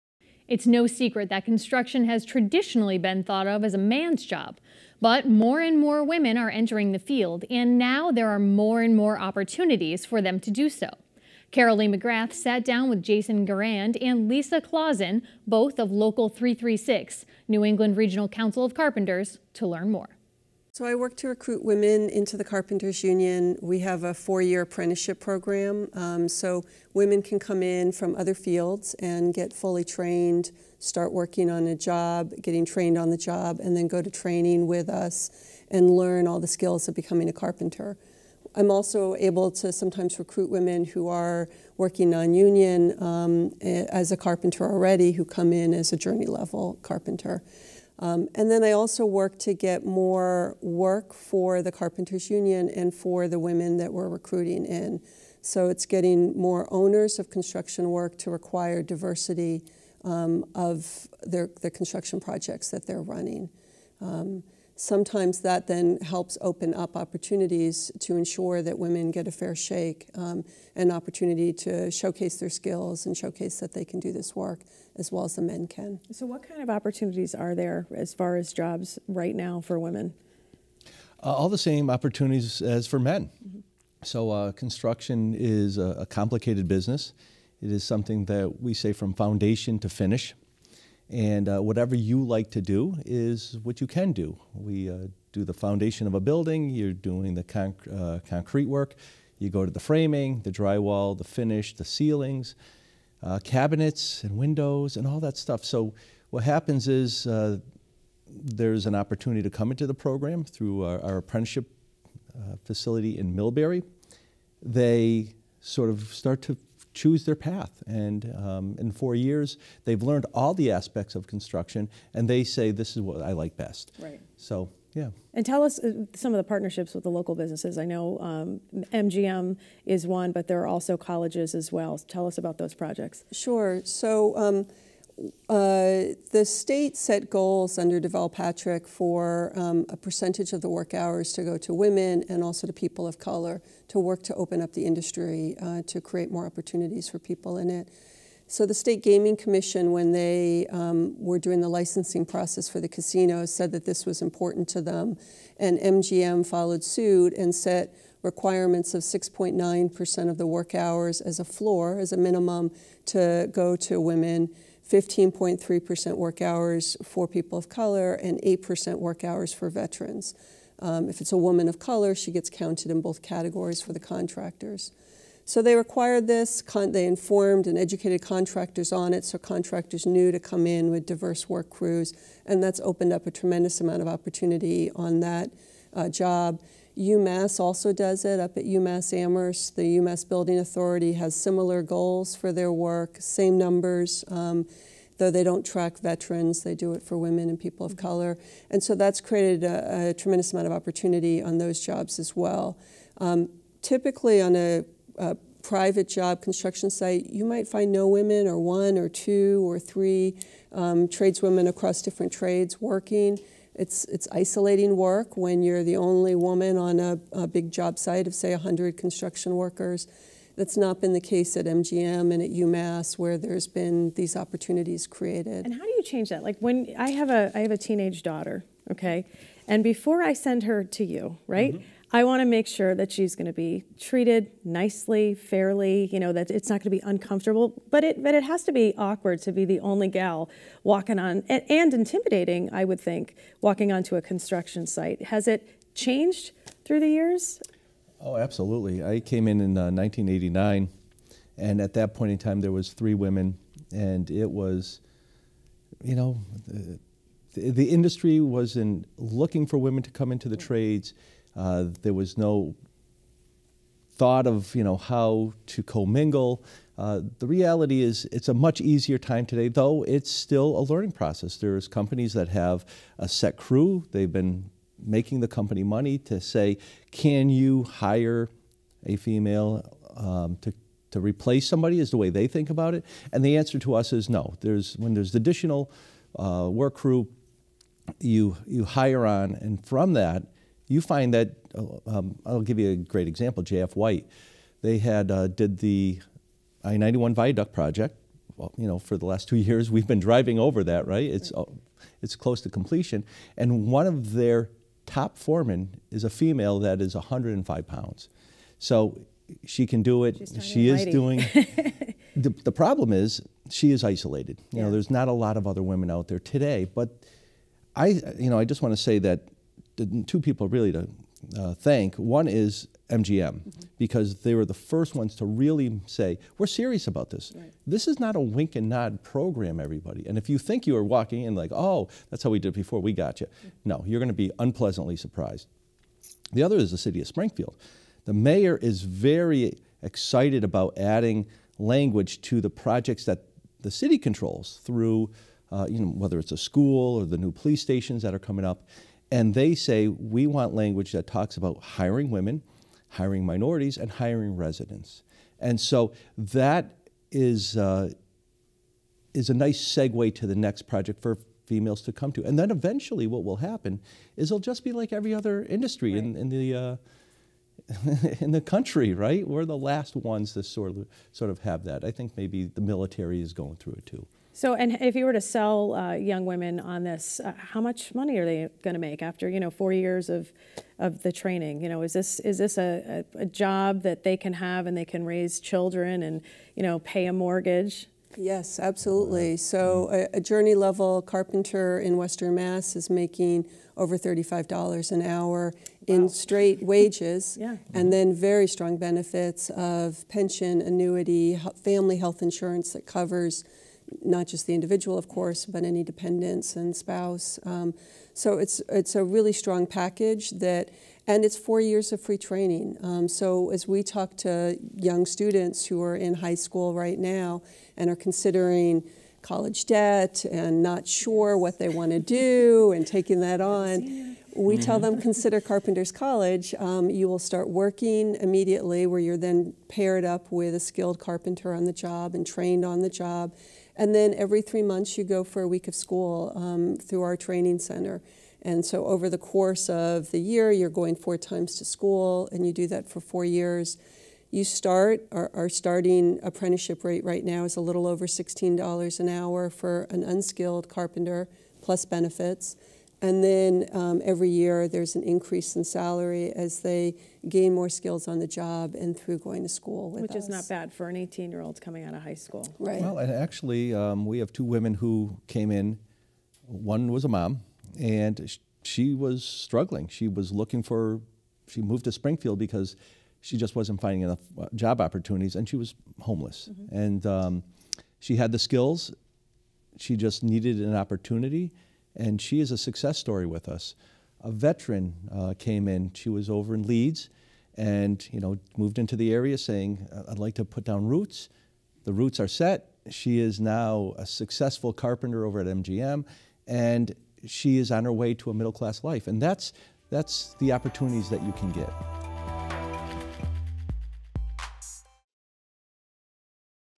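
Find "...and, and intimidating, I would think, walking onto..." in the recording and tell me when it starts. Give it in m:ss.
4:01.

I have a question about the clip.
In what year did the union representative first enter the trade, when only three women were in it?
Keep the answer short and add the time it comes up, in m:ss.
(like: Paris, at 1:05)
1989, at 4:09.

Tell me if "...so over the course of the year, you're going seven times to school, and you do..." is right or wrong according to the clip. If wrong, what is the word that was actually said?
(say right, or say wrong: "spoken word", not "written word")
wrong: "four", not "seven".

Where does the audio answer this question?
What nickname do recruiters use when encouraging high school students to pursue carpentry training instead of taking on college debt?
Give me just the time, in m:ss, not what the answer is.
7:05.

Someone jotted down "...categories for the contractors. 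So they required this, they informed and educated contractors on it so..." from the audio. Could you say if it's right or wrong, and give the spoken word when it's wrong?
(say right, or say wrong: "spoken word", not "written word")
right.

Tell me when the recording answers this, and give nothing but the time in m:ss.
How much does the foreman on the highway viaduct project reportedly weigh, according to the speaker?
5:07.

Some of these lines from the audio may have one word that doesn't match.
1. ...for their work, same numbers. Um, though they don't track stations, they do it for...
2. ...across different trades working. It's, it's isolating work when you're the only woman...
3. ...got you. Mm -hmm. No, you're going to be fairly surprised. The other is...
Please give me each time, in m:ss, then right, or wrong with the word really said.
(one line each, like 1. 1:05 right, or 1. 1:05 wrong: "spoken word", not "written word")
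1. 3:12 wrong: "veterans", not "stations"
2. 3:31 right
3. 5:33 wrong: "unpleasantly", not "fairly".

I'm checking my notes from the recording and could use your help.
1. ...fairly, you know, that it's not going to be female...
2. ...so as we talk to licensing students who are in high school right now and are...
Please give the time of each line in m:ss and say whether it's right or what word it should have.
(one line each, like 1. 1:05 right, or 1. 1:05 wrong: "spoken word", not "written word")
1. 3:55 wrong: "uncomfortable", not "female"
2. 6:53 wrong: "young", not "licensing".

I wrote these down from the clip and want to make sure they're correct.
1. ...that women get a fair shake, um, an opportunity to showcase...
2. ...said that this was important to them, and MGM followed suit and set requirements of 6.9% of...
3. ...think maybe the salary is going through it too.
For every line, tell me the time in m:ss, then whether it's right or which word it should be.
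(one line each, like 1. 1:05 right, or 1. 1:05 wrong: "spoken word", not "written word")
1. 1:08 right
2. 2:33 right
3. 6:12 wrong: "military", not "salary".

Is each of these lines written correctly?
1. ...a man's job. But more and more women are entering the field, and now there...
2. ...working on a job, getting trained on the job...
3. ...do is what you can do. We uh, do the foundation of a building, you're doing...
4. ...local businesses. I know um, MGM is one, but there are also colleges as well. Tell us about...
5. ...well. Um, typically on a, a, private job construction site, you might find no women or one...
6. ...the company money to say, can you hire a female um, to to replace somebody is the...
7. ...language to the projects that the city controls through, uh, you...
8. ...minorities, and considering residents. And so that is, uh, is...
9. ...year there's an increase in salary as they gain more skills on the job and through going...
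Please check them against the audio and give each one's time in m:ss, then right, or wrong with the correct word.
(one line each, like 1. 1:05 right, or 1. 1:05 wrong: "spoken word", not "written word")
1. 0:03 right
2. 0:31 right
3. 1:32 right
4. 2:07 right
5. 3:22 right
6. 4:35 right
7. 5:41 right
8. 5:53 wrong: "hiring", not "considering"
9. 7:34 right.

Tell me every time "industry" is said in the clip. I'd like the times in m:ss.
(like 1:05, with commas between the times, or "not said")
2:24, 4:17, 6:05.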